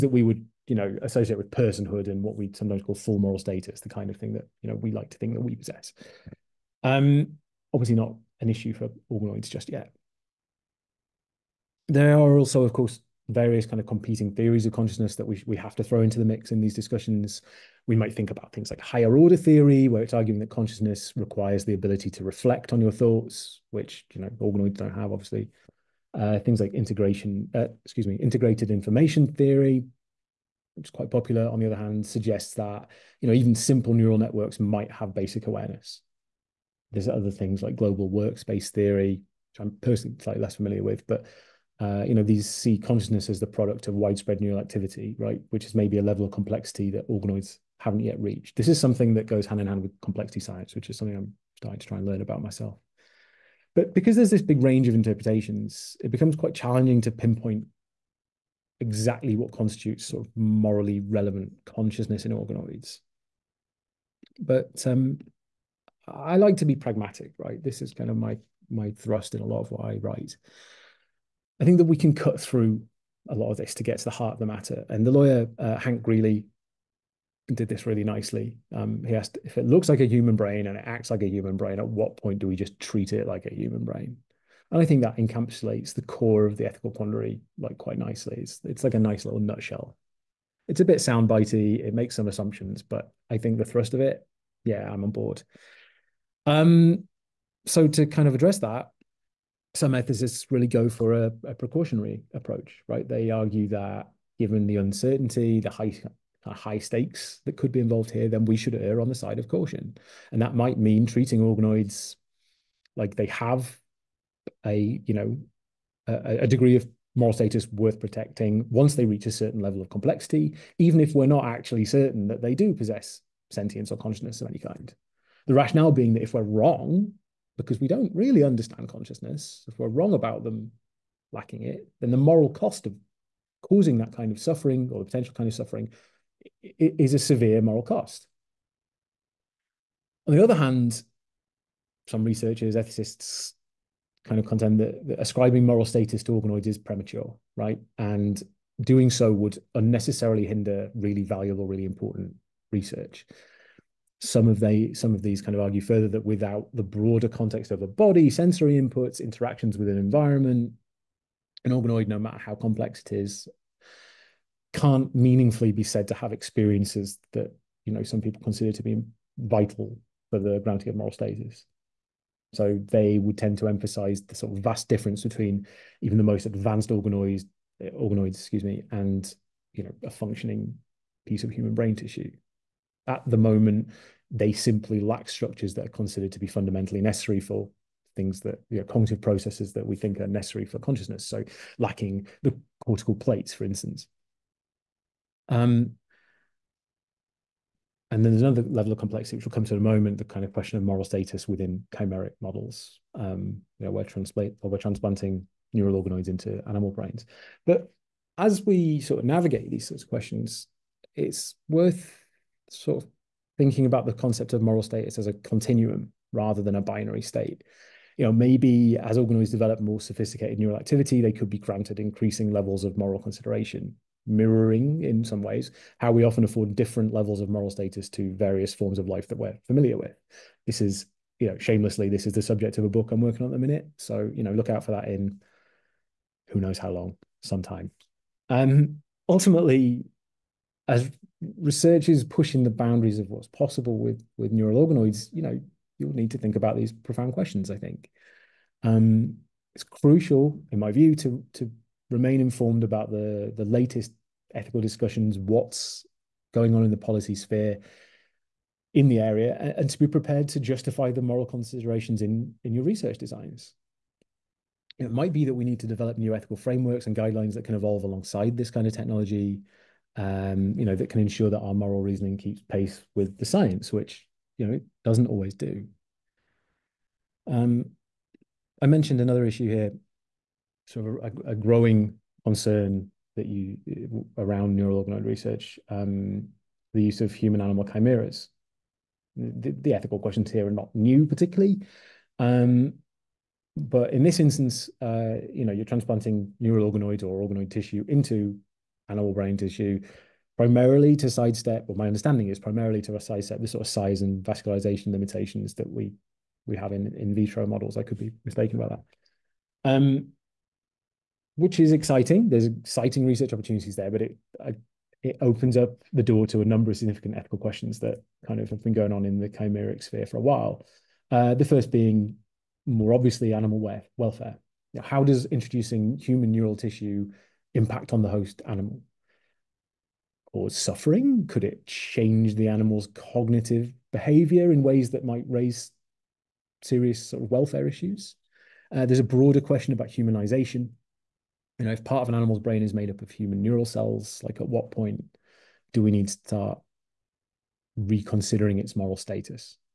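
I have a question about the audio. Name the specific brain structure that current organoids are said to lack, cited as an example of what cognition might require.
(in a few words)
Cortical plates.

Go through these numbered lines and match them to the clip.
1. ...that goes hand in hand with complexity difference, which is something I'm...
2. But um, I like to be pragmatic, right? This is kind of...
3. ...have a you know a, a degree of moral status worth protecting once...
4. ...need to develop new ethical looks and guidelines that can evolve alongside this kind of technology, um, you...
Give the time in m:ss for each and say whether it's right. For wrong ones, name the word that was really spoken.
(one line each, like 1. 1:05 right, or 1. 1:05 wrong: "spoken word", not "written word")
1. 0:49 wrong: "science", not "difference"
2. 1:04 right
3. 1:53 right
4. 4:25 wrong: "frameworks", not "looks".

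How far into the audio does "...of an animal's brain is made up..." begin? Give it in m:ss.
5:42.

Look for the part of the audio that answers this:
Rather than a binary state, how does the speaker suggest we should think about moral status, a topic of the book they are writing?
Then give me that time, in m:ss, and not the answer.
3:35.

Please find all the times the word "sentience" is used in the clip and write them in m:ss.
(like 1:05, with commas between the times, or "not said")
2:03.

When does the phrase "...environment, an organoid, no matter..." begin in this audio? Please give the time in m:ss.
2:39.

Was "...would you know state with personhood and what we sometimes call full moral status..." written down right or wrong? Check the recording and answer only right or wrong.
wrong.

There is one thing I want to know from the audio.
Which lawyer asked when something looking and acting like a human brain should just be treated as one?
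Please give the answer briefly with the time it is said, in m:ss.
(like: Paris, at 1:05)
Hank Greeley, at 1:15.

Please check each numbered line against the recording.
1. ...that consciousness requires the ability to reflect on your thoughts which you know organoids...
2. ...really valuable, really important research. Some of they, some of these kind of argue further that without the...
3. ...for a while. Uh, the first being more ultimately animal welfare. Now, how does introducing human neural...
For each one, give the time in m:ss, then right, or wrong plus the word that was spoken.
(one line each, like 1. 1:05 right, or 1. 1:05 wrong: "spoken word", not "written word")
1. 0:20 right
2. 2:30 right
3. 5:20 wrong: "obviously", not "ultimately".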